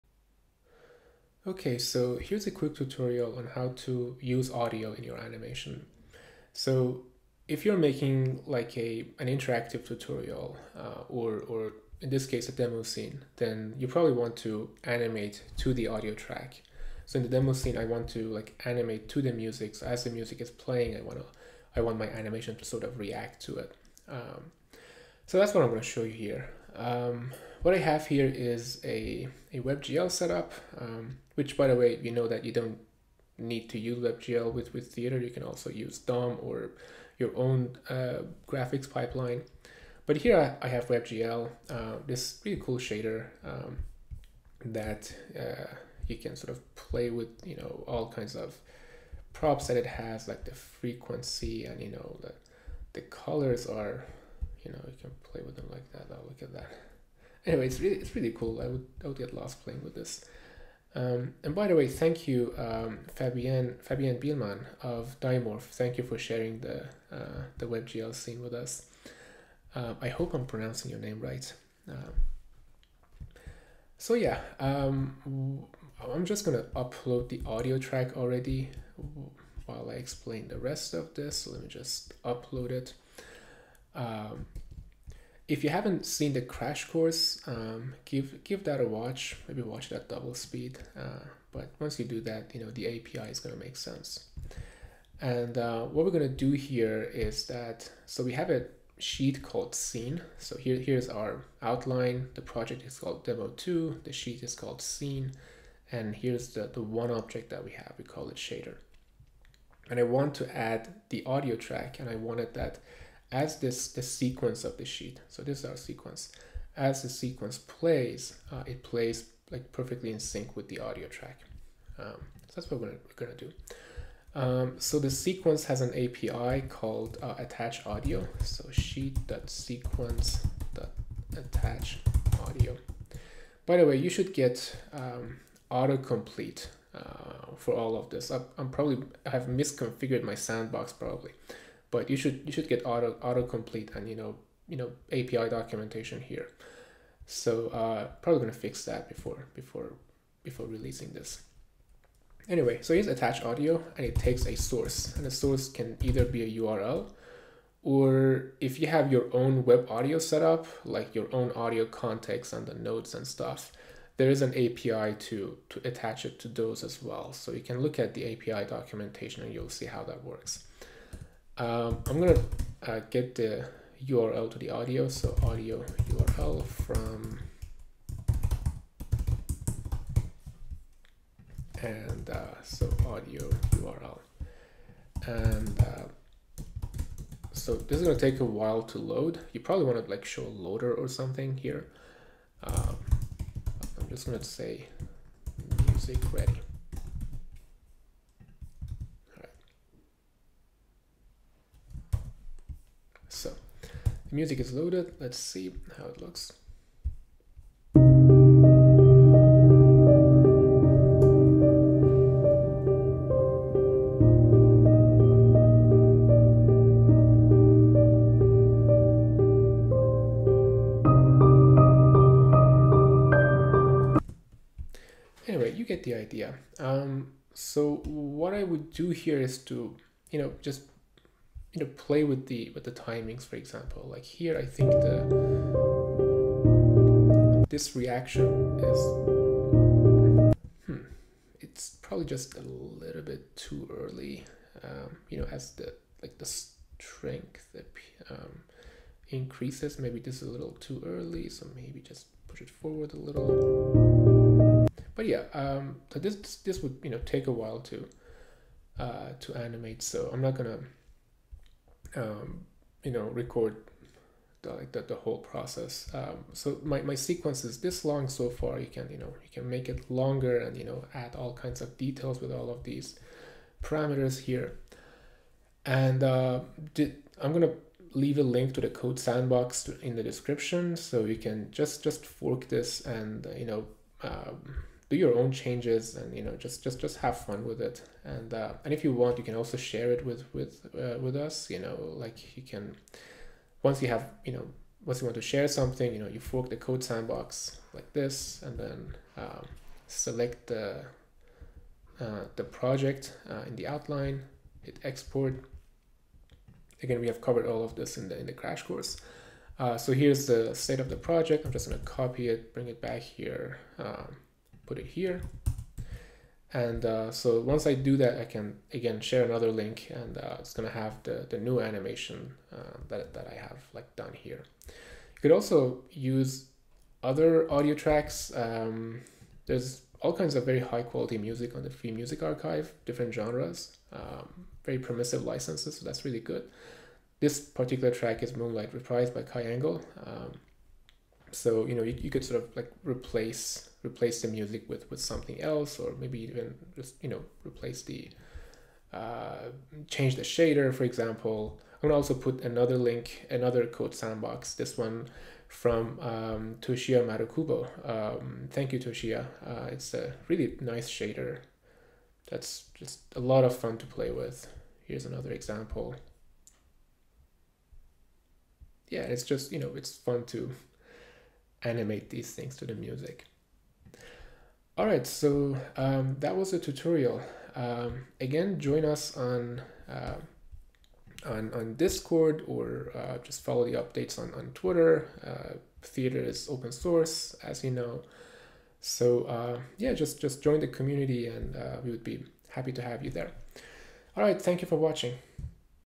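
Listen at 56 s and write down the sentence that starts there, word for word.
Oh, look at that anyway, it's really, it's really cool.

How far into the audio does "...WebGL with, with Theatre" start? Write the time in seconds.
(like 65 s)
33 s.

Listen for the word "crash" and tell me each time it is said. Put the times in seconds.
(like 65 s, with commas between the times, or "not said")
86 s, 308 s.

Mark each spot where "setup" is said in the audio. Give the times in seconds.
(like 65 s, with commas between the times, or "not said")
30 s, 160 s.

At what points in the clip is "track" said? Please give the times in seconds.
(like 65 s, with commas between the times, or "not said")
16 s, 77 s, 111 s, 121 s, 327 s, 338 s.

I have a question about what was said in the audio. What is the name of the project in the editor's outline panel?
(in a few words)
demo two.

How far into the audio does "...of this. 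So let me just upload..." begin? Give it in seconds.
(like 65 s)
80 s.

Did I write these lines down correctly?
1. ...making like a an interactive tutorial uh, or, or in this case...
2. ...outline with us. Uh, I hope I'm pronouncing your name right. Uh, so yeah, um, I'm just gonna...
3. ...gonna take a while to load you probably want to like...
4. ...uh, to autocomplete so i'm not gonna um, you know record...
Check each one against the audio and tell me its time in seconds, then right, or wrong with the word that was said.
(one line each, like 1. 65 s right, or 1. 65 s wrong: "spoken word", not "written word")
1. 7 s right
2. 68 s wrong: "scene", not "outline"
3. 188 s right
4. 258 s wrong: "animate", not "autocomplete".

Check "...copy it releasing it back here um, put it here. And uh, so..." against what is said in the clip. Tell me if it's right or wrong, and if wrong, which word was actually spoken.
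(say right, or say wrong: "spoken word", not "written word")
wrong: "bring", not "releasing".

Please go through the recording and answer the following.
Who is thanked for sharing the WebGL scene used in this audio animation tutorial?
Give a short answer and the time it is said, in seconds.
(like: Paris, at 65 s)
Fabienne Bielmann, at 63 s.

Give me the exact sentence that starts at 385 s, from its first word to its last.
Uh, Theatre is open source, as you know.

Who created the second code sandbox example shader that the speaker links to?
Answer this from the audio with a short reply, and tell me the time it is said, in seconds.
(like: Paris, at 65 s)
Toshiya Marukubo, at 356 s.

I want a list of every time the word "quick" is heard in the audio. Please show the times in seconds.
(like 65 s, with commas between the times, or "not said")
2 s.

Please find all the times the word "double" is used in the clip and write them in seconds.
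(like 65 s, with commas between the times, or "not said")
90 s.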